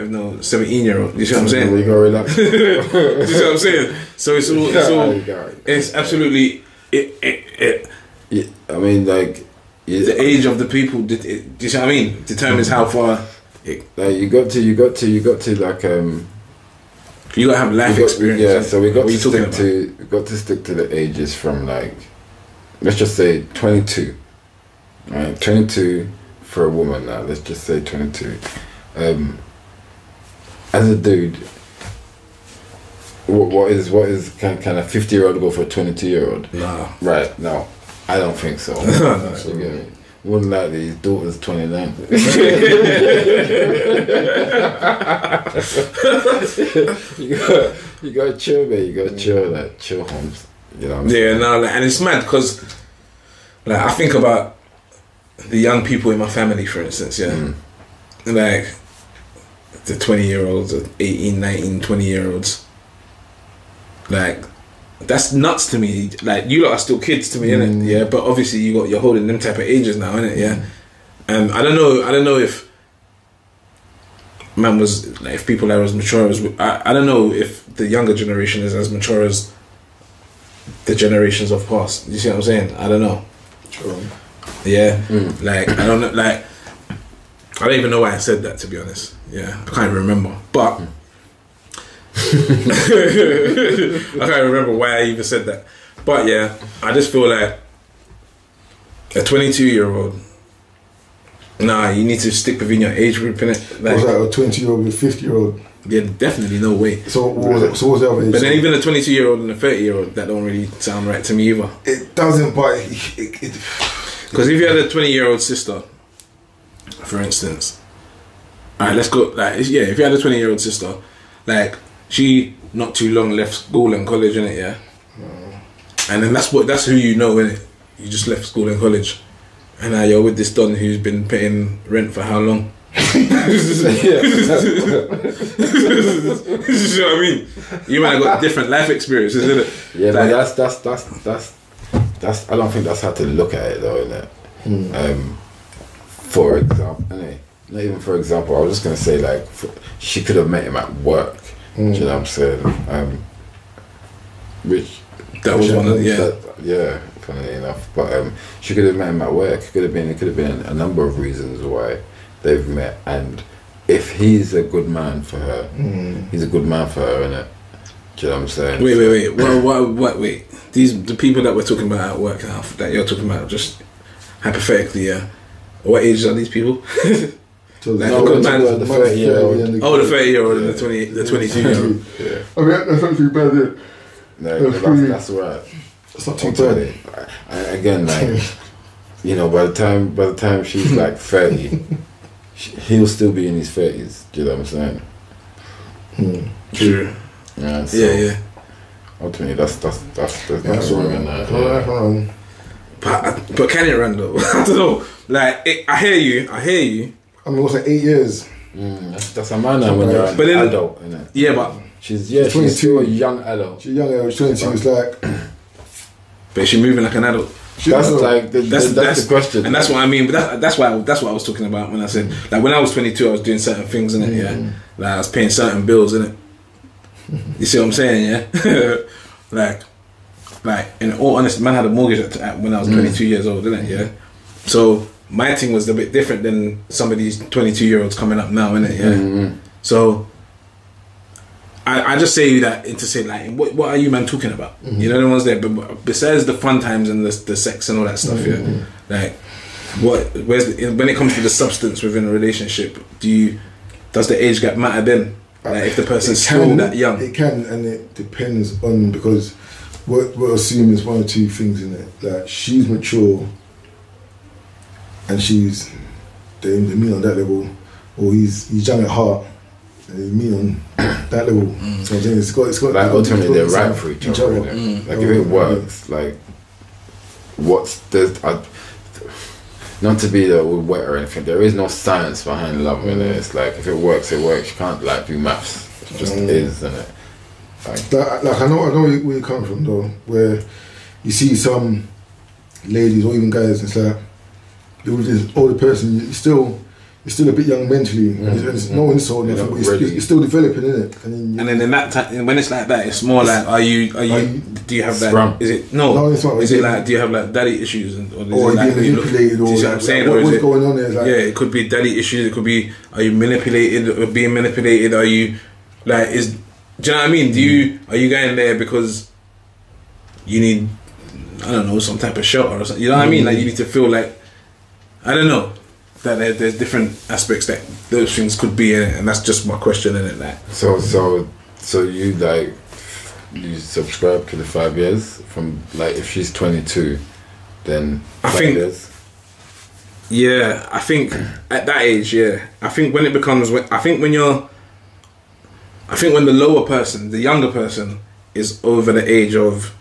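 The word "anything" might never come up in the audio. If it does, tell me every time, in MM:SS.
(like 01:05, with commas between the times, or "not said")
04:41.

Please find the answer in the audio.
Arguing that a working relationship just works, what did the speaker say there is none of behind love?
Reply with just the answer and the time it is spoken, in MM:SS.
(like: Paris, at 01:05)
Science, at 04:41.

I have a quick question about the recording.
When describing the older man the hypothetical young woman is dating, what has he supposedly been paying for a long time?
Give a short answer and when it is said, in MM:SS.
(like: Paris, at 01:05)
Rent, at 02:11.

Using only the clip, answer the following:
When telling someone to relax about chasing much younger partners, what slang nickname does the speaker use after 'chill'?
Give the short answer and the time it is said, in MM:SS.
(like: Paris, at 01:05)
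Holmes, at 00:50.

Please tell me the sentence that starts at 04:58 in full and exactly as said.
There's no insult, yeah, but you're, still developing, in it?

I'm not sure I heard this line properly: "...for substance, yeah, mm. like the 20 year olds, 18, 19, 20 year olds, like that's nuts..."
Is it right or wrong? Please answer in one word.
wrong.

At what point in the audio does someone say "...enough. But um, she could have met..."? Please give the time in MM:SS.
02:37.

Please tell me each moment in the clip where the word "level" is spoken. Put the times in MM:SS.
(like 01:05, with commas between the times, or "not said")
04:27, 04:31.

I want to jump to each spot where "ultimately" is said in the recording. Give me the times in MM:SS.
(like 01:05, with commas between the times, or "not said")
03:19, 04:33.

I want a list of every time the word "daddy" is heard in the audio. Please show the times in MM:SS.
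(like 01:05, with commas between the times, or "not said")
05:07, 05:11.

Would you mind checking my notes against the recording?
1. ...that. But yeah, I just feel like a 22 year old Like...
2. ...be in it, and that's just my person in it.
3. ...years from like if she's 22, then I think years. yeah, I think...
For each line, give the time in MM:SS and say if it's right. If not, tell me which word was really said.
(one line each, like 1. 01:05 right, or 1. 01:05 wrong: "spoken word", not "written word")
1. 01:35 wrong: "Nah", not "Like"
2. 05:28 wrong: "question", not "person"
3. 05:34 right.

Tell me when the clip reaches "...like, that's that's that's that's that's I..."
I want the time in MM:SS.
02:20.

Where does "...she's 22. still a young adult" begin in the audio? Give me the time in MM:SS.
03:32.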